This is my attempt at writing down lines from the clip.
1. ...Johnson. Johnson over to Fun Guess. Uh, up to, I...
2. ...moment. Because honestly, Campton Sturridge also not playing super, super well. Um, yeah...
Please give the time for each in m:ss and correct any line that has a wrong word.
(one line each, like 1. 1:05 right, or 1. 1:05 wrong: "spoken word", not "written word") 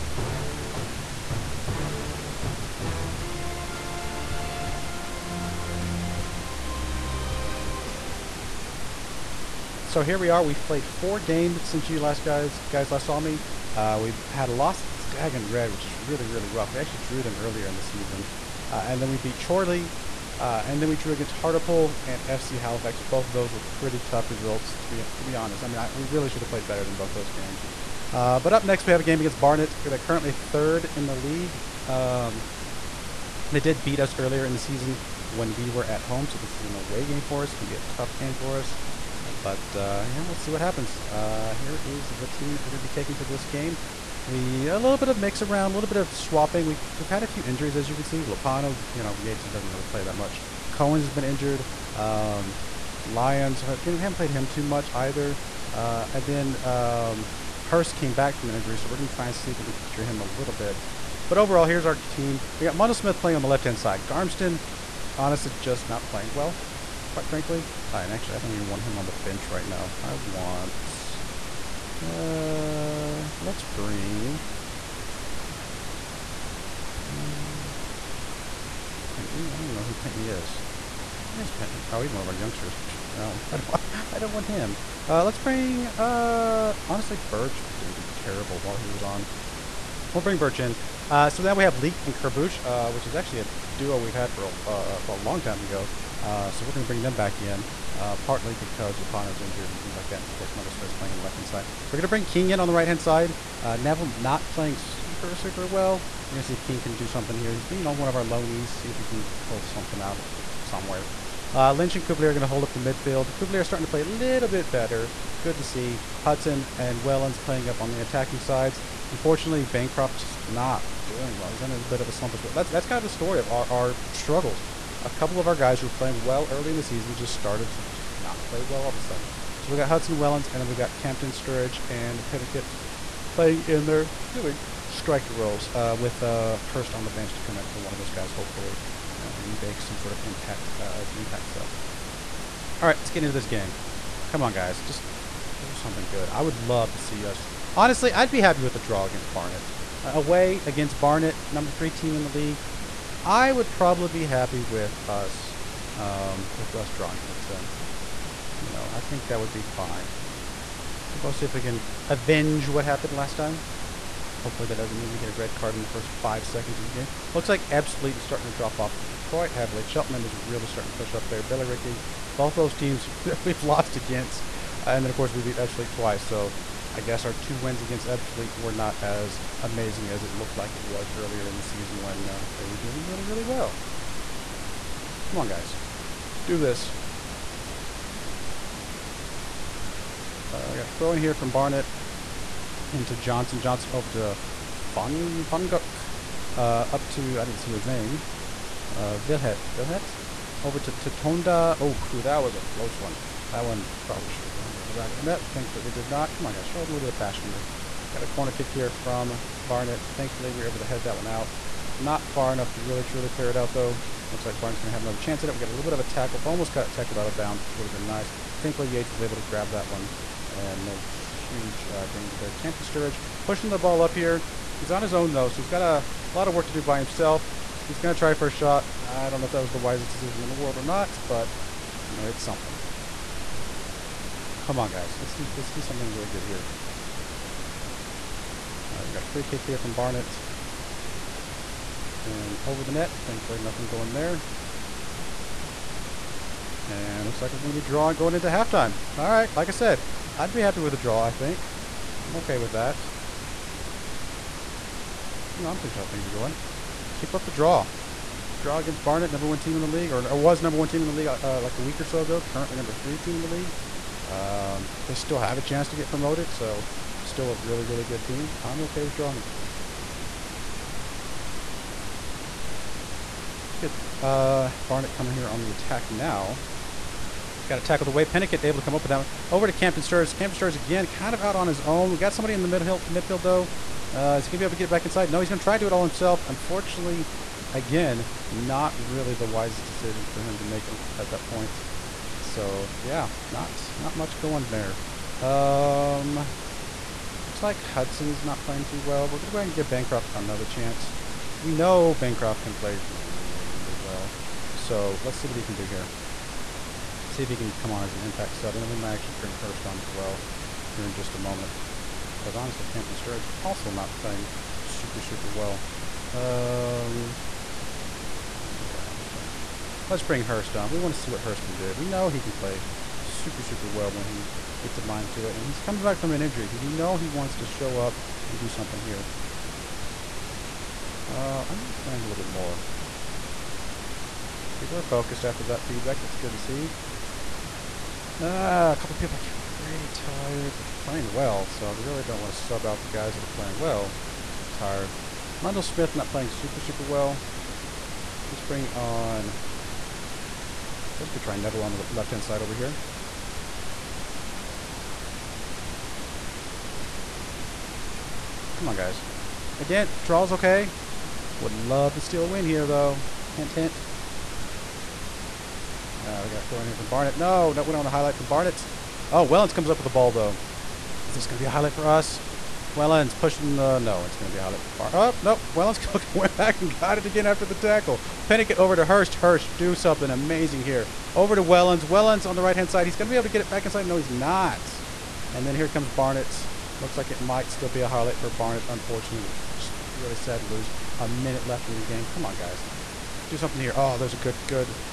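1. 3:13 wrong: "Funguk", not "Guess"
2. 5:11 right.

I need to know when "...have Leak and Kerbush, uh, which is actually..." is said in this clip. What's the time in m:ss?
1:31.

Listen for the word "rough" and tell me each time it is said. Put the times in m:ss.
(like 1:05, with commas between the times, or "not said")
0:16.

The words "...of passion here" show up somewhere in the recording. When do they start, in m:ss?
3:27.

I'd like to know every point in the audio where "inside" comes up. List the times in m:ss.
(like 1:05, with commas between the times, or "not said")
4:45, 6:23.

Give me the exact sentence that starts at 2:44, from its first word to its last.
Hopefully that doesn't mean we get a red card in the first five seconds of the game.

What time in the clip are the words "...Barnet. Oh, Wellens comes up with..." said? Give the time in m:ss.
6:08.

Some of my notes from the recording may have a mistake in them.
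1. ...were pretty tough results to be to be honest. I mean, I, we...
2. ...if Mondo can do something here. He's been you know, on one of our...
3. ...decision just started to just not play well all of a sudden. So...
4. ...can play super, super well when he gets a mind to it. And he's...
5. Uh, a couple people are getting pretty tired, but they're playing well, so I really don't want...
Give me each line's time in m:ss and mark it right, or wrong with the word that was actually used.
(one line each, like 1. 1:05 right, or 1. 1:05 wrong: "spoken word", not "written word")
1. 0:23 right
2. 1:46 wrong: "King", not "Mondo"
3. 2:06 wrong: "season", not "decision"
4. 5:22 right
5. 5:38 right.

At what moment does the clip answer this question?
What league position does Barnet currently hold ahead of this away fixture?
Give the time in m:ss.
0:30.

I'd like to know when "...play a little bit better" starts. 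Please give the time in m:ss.
1:53.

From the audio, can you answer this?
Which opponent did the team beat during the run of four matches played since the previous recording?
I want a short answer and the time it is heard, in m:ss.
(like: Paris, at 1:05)
Chorley, at 0:19.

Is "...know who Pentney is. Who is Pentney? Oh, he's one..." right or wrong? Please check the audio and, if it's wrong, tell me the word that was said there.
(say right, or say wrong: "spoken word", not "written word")
right.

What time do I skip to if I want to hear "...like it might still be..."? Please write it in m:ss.
6:27.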